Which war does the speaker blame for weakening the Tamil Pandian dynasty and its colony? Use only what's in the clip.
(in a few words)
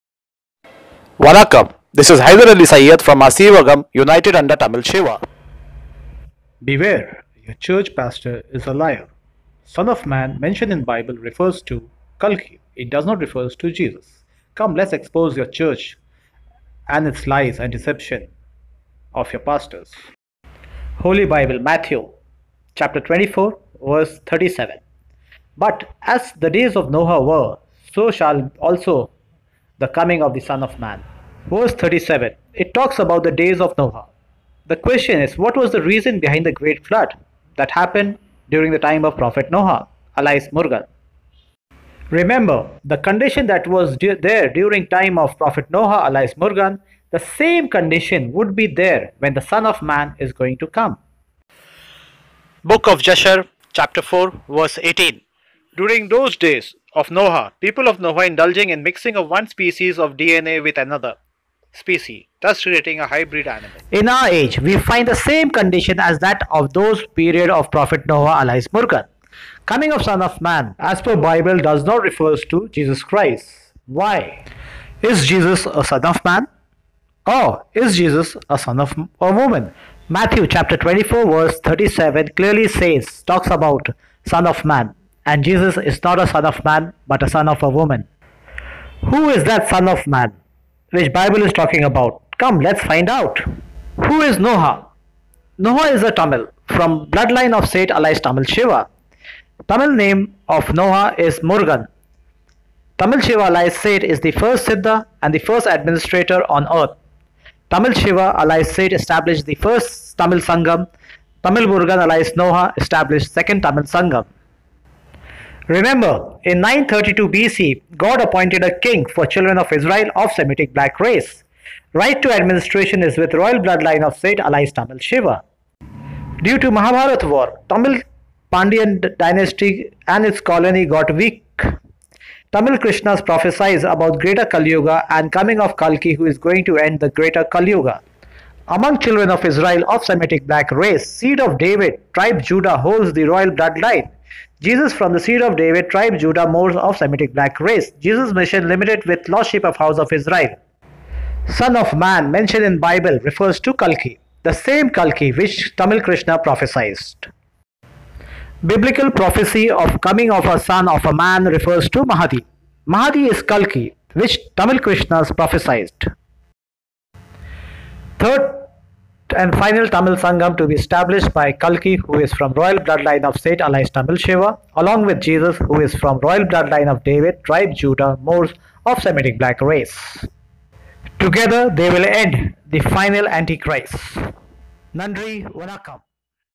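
Mahabharat war.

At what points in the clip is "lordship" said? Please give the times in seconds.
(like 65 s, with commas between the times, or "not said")
149 s.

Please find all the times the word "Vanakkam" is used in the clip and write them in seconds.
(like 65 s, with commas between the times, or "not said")
1 s, 185 s.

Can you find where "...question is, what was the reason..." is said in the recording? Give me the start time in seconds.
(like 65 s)
34 s.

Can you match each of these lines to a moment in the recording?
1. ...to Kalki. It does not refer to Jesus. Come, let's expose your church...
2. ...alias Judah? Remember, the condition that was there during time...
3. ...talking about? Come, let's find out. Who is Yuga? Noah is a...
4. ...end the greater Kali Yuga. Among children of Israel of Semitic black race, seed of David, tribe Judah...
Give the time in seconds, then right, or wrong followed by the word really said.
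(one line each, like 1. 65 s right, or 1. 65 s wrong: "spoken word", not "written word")
1. 11 s right
2. 40 s wrong: "Murgan", not "Judah"
3. 91 s wrong: "Noah", not "Yuga"
4. 136 s right.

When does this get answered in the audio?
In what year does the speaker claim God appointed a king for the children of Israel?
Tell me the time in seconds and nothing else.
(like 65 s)
116 s.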